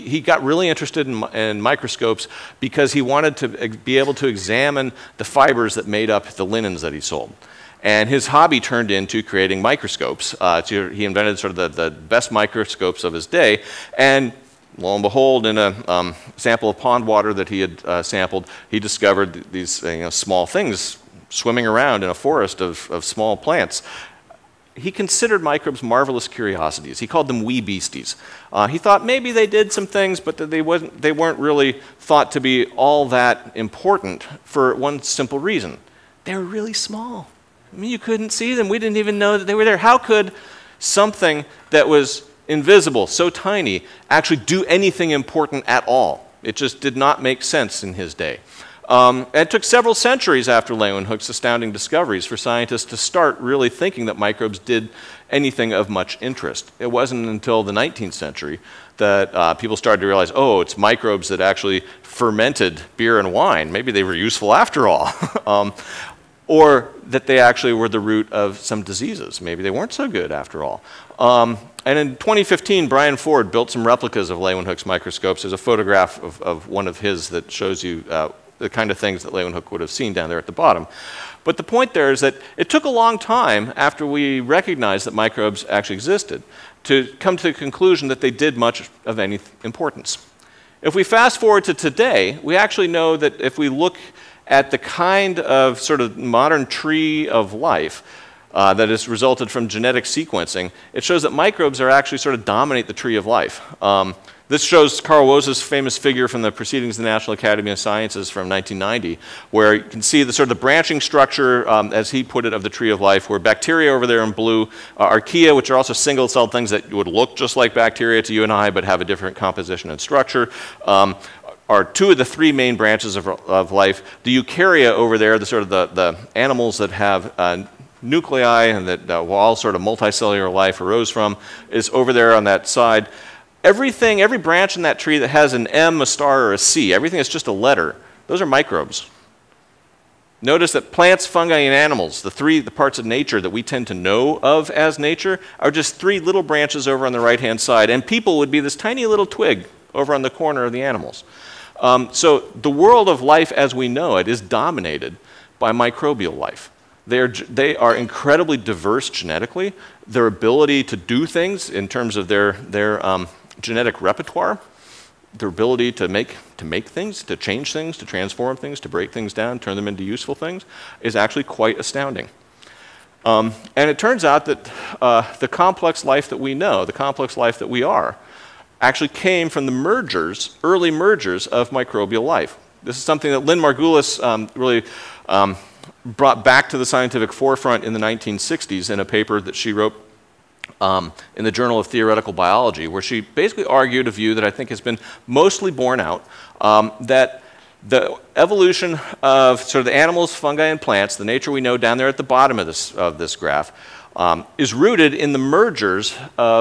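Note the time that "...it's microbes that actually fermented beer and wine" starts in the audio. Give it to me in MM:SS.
01:00.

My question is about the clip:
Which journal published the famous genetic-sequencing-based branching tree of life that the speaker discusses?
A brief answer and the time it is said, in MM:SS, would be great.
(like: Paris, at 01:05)
Proceedings of the National Academy of Sciences, at 01:46.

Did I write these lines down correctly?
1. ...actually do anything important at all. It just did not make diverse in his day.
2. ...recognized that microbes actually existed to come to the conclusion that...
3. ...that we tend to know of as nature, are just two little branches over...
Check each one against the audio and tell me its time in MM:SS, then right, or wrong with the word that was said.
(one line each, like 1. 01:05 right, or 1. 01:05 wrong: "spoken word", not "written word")
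1. 00:44 wrong: "sense", not "diverse"
2. 01:24 right
3. 02:23 wrong: "three", not "two".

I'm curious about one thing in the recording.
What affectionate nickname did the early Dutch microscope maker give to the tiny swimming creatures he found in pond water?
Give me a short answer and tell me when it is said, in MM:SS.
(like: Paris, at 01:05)
wee beasties, at 00:27.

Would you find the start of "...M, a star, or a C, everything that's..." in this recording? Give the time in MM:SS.
02:15.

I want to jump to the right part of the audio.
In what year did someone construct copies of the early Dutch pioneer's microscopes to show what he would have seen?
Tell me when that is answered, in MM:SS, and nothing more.
01:12.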